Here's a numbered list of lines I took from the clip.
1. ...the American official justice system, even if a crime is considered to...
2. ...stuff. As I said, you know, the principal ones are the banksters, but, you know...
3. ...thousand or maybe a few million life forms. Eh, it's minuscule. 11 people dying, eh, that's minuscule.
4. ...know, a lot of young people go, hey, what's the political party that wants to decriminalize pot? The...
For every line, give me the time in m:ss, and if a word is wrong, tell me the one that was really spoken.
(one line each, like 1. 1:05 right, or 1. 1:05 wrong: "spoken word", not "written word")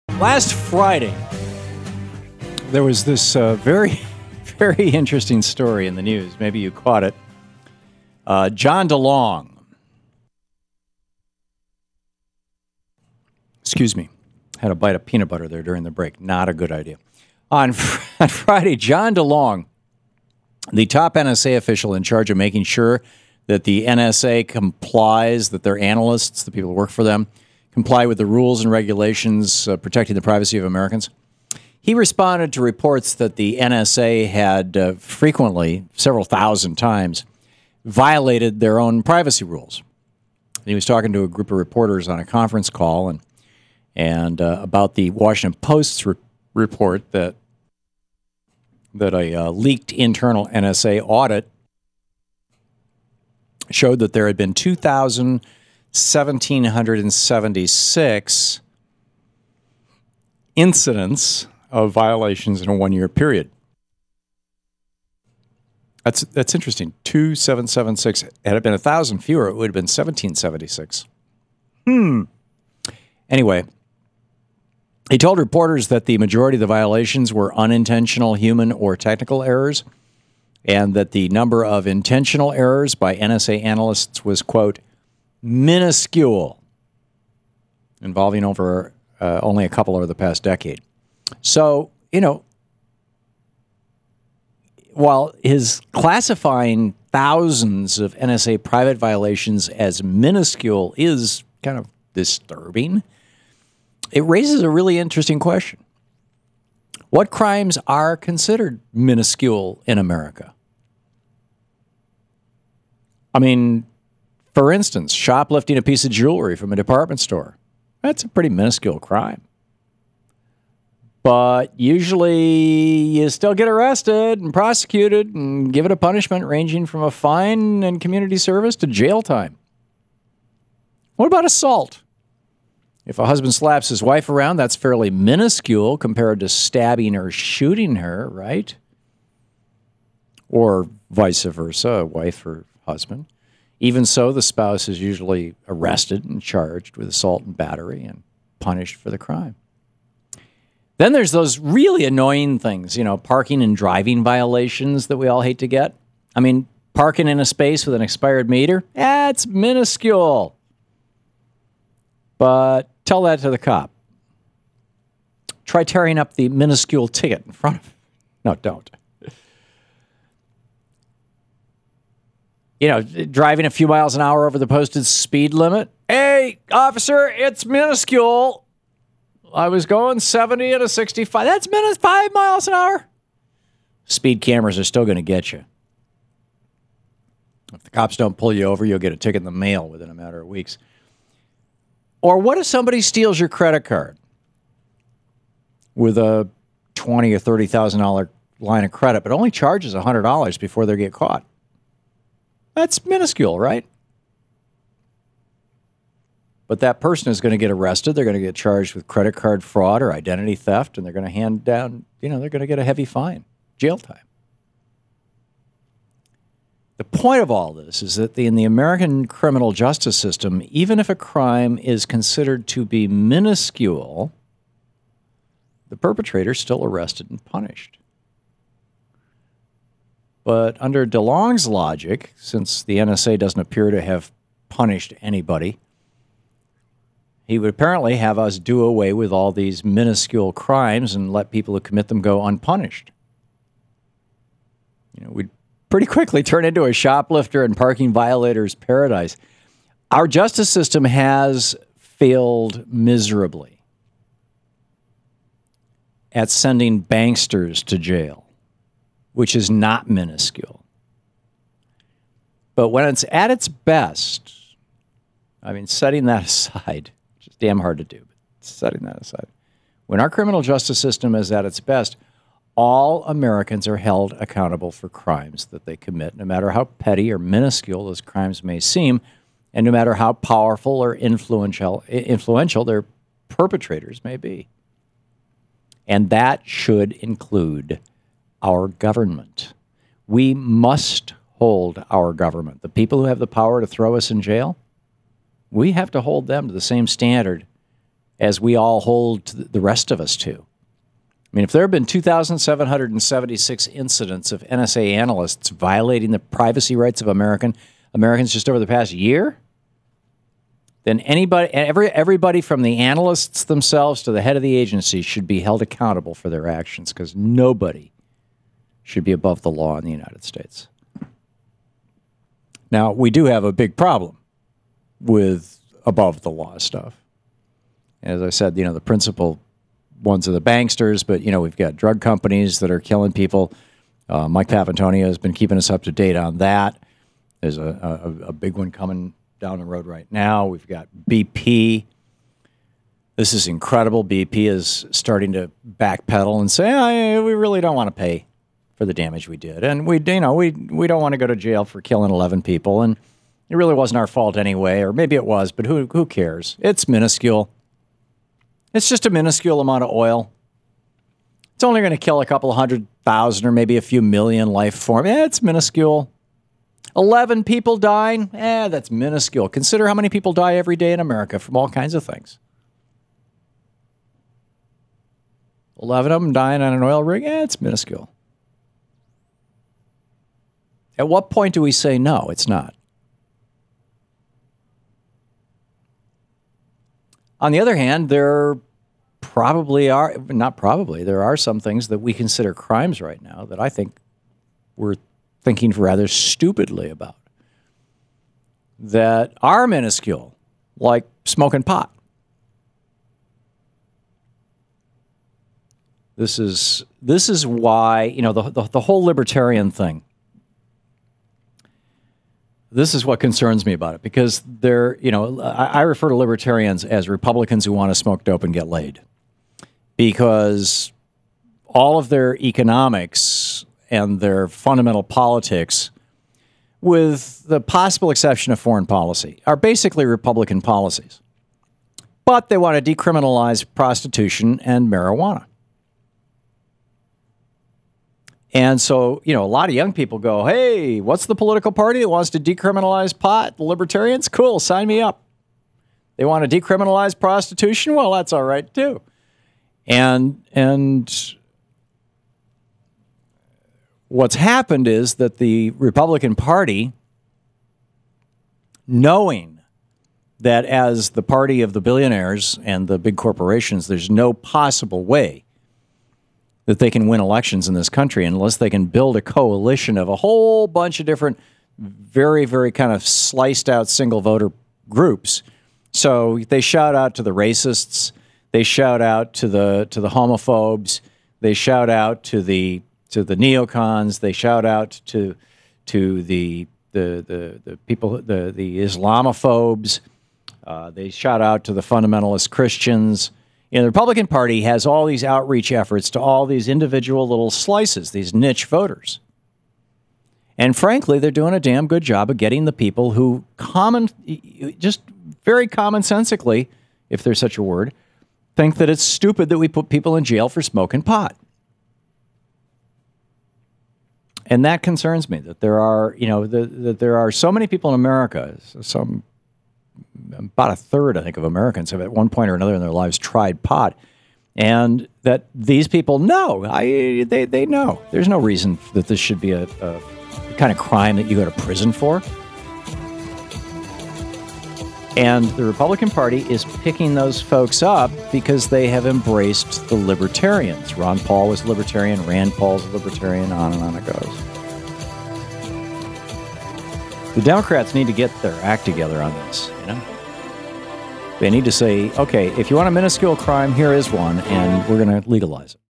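1. 3:38 wrong: "criminal", not "official"
2. 5:26 right
3. 6:03 right
4. 7:19 right.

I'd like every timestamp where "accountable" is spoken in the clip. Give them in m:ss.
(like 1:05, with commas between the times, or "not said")
4:34, 5:15.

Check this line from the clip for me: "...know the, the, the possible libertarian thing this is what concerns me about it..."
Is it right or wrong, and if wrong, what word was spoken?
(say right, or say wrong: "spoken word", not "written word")
wrong: "whole", not "possible".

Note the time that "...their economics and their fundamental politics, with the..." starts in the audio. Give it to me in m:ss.
7:02.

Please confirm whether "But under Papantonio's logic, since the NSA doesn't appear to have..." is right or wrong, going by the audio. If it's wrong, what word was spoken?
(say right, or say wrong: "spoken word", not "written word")
wrong: "DeLong", not "Papantonio".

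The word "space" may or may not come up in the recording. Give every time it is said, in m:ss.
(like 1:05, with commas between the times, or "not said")
2:37.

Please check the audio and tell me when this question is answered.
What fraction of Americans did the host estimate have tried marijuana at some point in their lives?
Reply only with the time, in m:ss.
8:40.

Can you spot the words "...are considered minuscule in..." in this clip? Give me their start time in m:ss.
1:47.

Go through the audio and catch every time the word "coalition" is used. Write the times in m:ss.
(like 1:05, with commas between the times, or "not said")
7:49.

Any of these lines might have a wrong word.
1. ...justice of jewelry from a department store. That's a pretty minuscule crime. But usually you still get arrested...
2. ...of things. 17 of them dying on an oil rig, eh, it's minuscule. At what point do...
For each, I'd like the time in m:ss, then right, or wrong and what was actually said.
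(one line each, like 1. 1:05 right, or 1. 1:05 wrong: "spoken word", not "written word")
1. 1:55 wrong: "piece", not "justice"
2. 6:12 wrong: "11", not "17".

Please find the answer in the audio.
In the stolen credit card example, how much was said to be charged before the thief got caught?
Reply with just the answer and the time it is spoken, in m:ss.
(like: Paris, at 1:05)
100 dollars, at 3:19.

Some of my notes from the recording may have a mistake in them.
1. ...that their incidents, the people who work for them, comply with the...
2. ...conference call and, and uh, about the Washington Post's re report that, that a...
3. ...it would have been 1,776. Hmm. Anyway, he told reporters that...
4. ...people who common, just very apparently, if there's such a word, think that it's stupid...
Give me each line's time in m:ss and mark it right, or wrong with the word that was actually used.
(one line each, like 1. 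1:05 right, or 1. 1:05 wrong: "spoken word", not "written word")
1. 0:25 wrong: "analysts", not "incidents"
2. 0:42 right
3. 1:09 right
4. 8:22 wrong: "commonsensically", not "apparently".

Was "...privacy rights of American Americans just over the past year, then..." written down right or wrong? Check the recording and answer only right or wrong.
right.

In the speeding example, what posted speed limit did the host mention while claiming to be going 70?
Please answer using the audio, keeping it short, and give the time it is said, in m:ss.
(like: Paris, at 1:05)
65, at 3:00.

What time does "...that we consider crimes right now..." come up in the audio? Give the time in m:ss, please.
6:32.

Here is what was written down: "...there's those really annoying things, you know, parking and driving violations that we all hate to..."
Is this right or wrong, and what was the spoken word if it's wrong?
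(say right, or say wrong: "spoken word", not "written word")
right.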